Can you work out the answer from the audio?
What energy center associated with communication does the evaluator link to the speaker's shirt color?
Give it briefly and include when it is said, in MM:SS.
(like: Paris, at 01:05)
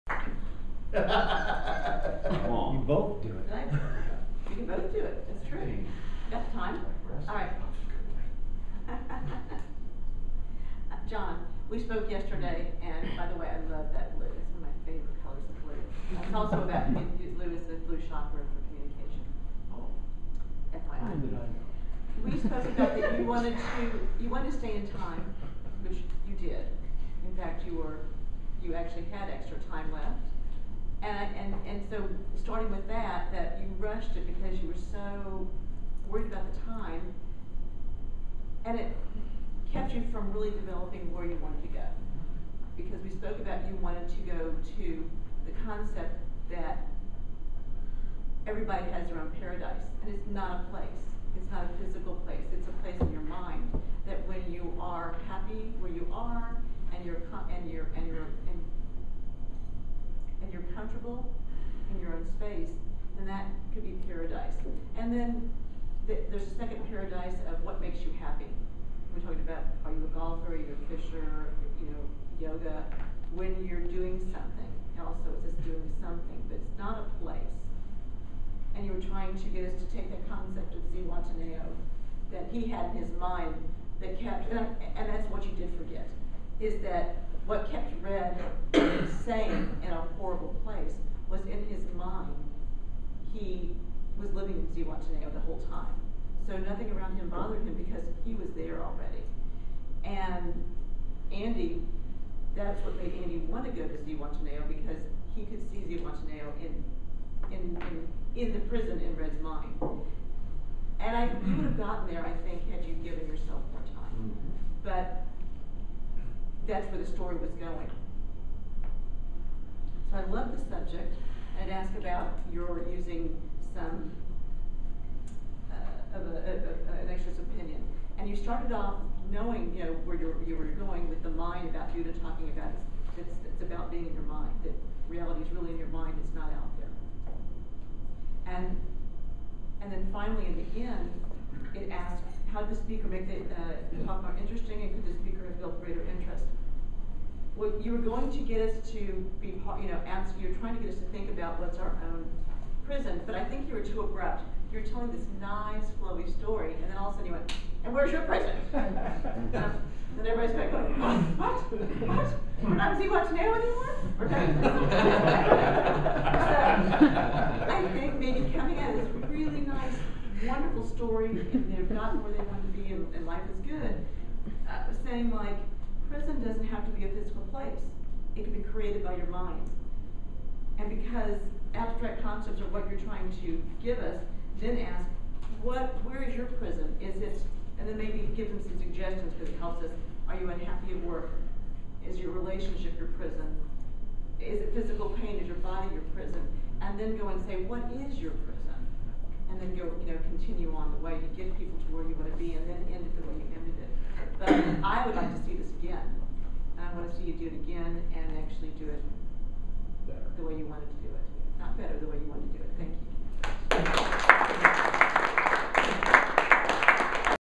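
Blue chakra, at 00:17.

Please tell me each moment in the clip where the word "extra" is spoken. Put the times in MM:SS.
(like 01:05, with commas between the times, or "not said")
00:29, 02:07.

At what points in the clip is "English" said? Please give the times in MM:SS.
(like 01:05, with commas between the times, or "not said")
not said.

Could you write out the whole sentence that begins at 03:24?
But I would like to see this again.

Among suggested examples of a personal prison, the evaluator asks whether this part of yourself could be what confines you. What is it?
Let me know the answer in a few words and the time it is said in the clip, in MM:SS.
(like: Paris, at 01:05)
Your body, at 03:15.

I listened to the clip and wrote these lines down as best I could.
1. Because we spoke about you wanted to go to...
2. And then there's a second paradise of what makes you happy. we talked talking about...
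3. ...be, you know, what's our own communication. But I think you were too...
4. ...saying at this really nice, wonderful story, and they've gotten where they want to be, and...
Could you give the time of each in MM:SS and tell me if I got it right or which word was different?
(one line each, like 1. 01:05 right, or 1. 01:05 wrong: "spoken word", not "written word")
1. 00:42 right
2. 01:04 right
3. 02:29 wrong: "prison", not "communication"
4. 02:48 wrong: "coming", not "saying".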